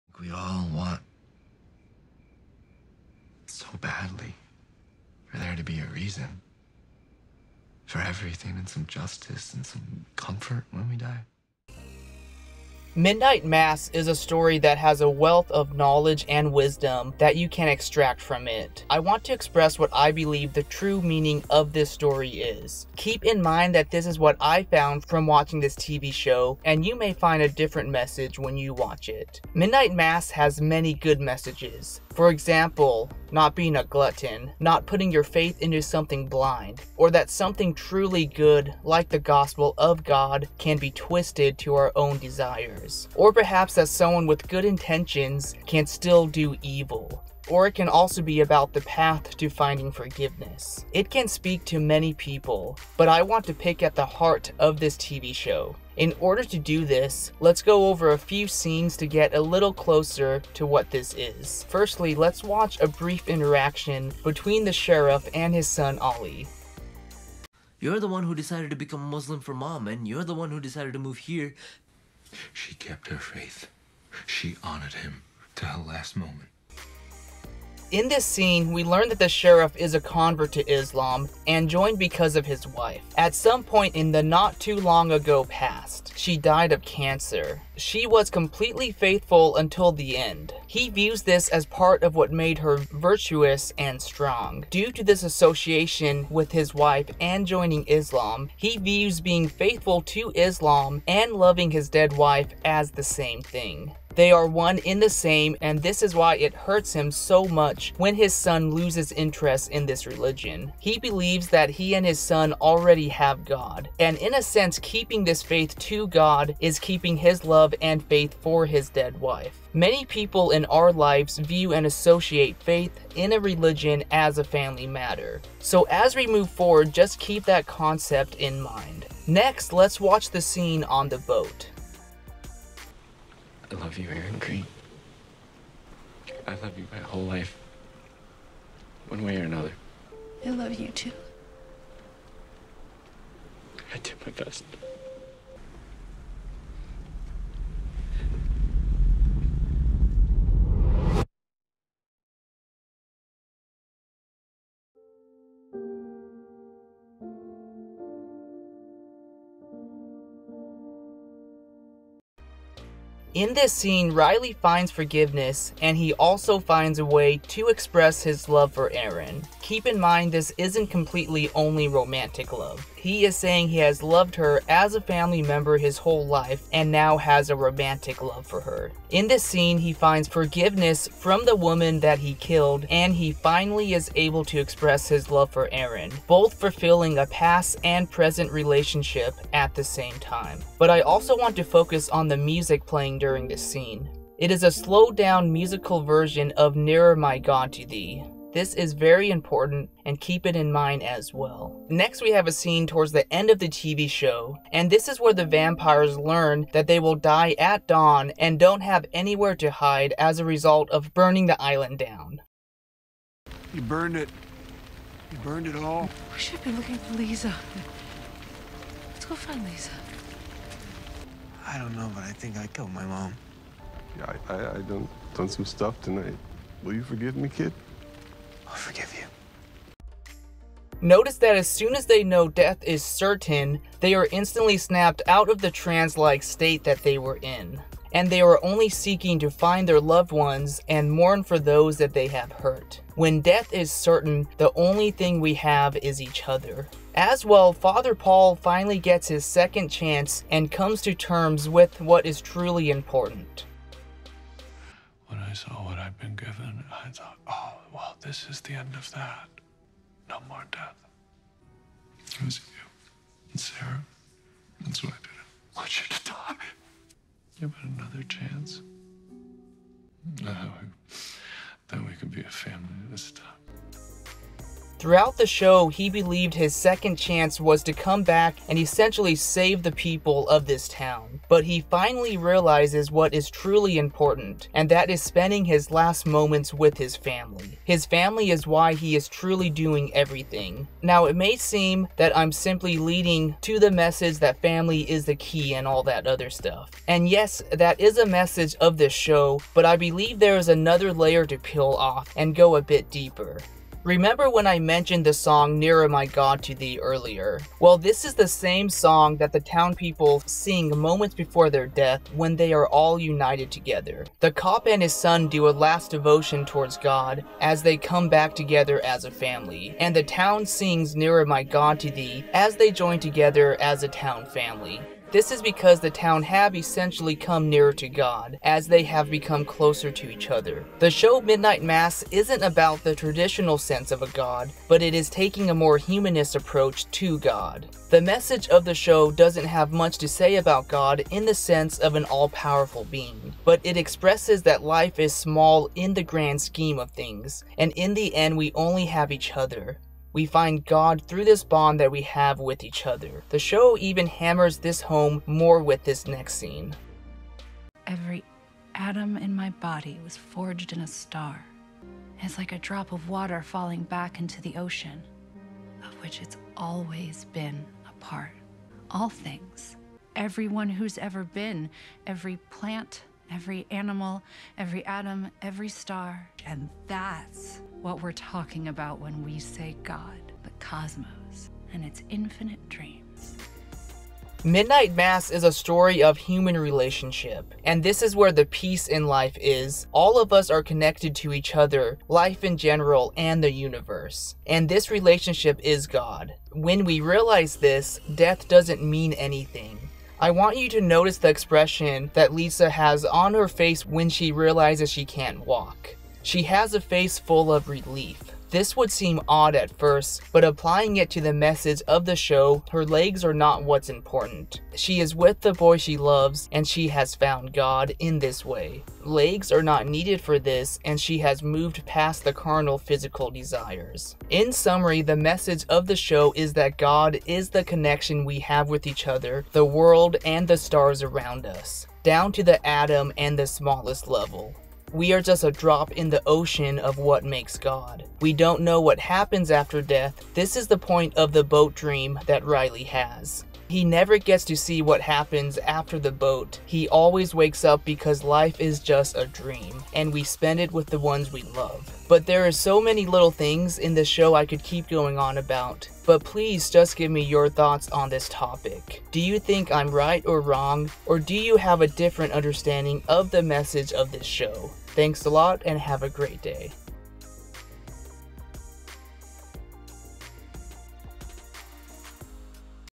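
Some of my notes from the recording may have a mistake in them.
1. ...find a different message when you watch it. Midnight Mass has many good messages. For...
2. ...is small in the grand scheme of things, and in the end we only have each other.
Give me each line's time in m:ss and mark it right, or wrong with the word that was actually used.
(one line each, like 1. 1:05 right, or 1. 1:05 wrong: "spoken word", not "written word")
1. 0:27 right
2. 5:45 right.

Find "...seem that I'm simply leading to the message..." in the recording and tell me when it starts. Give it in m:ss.
4:51.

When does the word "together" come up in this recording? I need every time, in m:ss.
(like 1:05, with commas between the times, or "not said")
5:13, 5:18, 5:23.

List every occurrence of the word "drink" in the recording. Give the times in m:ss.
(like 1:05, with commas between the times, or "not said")
not said.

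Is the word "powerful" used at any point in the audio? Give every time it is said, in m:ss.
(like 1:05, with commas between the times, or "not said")
5:42.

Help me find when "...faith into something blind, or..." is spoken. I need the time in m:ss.
0:35.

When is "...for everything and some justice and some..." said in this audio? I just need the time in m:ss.
0:07.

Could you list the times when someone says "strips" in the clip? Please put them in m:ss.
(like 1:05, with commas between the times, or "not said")
not said.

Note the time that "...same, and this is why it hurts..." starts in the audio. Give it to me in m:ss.
1:45.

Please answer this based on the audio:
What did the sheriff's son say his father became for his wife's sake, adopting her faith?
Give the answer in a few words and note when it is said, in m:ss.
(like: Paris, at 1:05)
Muslim, at 1:09.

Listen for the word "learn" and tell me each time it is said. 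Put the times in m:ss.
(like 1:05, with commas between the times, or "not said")
1:18, 3:26.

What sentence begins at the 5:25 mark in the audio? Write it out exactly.
This is because the town have essentially come nearer to God, as they have become closer to each other.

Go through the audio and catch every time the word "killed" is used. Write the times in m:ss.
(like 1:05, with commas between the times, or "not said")
3:02, 3:42.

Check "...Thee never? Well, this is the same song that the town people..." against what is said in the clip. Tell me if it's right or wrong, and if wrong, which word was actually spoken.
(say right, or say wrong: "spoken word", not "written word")
wrong: "earlier", not "never".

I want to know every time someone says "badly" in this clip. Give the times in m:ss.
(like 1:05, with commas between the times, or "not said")
0:03.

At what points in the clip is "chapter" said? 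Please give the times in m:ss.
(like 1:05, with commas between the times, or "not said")
not said.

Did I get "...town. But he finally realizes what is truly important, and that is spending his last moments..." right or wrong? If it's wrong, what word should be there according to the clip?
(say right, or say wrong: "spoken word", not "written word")
right.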